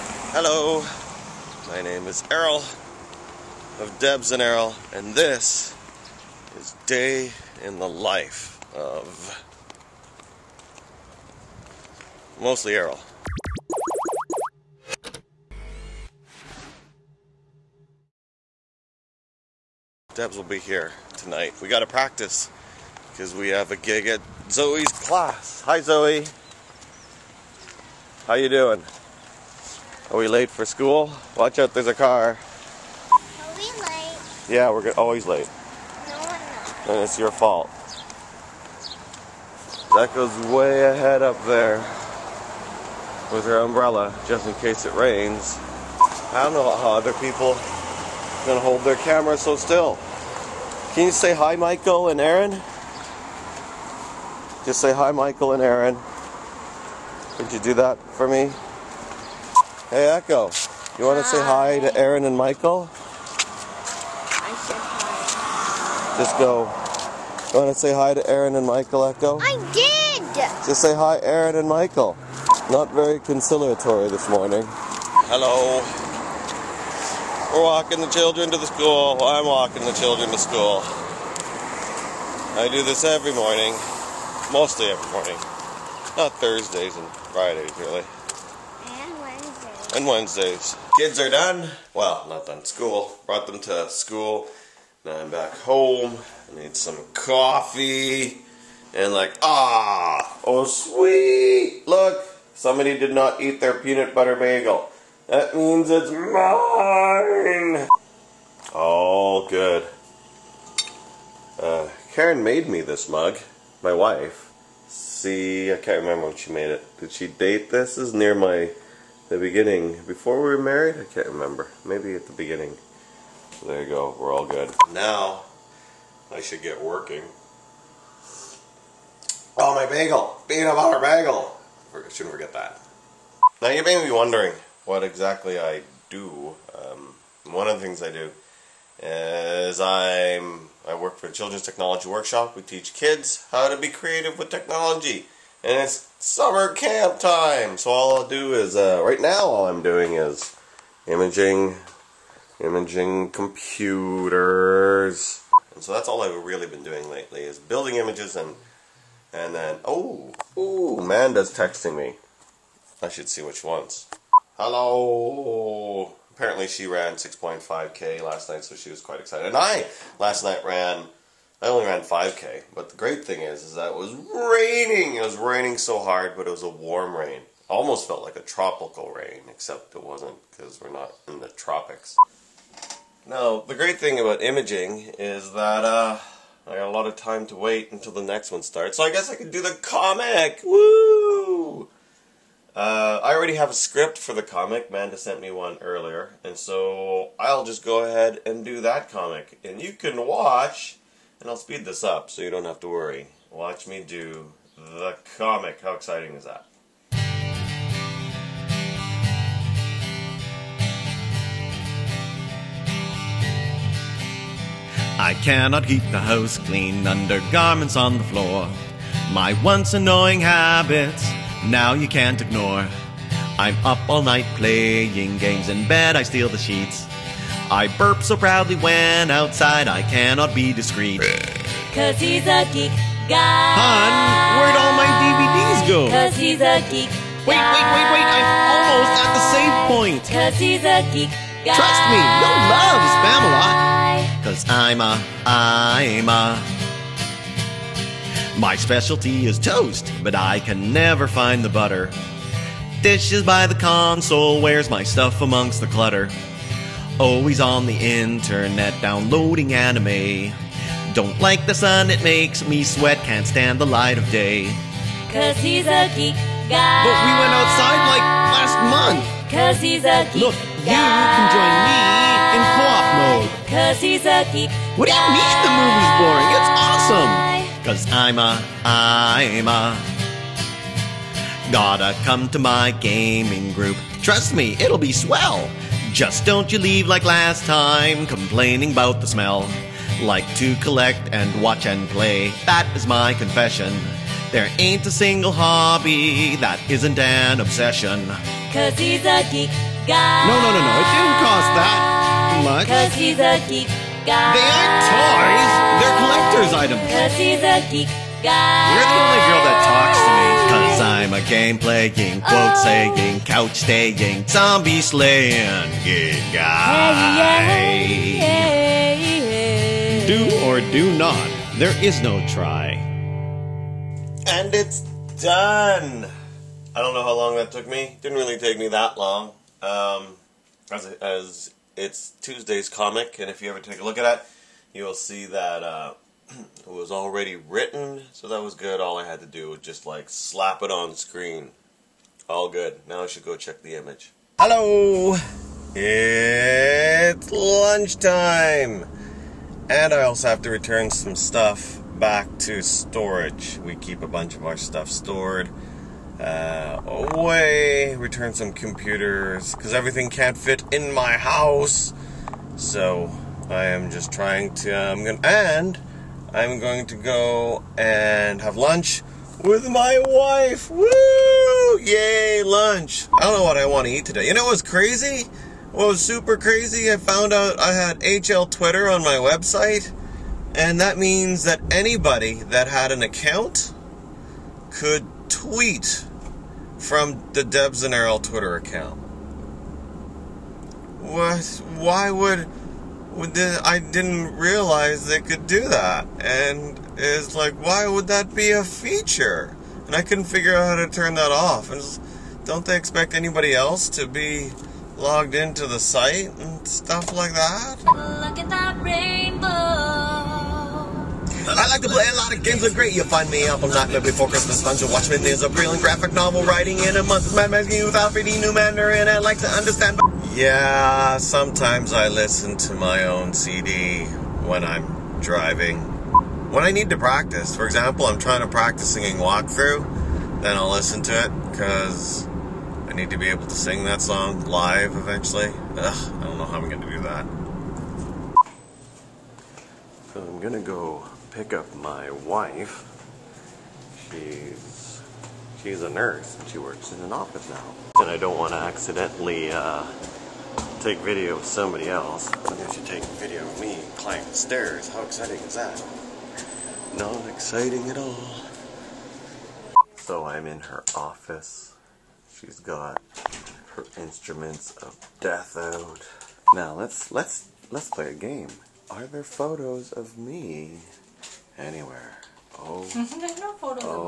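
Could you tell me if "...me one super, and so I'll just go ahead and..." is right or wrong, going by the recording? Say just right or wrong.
wrong.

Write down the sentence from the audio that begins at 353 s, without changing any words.
We keep a bunch of our stuff stored uh, away.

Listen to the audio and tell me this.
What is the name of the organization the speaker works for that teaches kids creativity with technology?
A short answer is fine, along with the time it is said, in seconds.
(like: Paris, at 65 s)
Children's Technology Workshop, at 141 s.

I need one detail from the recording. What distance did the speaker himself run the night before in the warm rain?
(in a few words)
5K.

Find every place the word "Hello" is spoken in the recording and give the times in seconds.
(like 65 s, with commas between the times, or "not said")
0 s, 75 s, 164 s, 344 s.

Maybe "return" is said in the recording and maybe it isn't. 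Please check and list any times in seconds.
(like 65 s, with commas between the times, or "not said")
350 s, 358 s.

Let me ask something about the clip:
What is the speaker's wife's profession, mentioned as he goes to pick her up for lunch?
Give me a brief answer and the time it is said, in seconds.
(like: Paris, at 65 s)
Nurse, at 446 s.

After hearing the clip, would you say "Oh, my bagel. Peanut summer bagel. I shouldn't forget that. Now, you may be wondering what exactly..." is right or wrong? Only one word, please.
wrong.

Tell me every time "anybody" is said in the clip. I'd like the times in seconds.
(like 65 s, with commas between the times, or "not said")
381 s, 403 s.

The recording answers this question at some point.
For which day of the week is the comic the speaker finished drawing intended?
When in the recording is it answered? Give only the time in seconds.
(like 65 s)
332 s.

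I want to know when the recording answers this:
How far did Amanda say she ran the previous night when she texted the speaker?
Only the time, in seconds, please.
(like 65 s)
167 s.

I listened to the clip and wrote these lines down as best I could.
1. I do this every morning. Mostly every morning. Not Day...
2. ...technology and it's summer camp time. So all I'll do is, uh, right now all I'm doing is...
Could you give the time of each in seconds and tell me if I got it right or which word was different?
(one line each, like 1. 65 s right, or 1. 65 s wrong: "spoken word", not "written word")
1. 82 s wrong: "Thursdays", not "Day"
2. 144 s right.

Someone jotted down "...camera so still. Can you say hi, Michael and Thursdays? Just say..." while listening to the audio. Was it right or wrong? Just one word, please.
wrong.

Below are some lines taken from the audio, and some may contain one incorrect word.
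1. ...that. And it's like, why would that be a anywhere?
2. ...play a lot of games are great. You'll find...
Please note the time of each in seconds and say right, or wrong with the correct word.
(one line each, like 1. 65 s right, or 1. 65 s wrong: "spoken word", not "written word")
1. 395 s wrong: "feature", not "anywhere"
2. 412 s right.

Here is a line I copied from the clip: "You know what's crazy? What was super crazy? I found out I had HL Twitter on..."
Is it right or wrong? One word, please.
right.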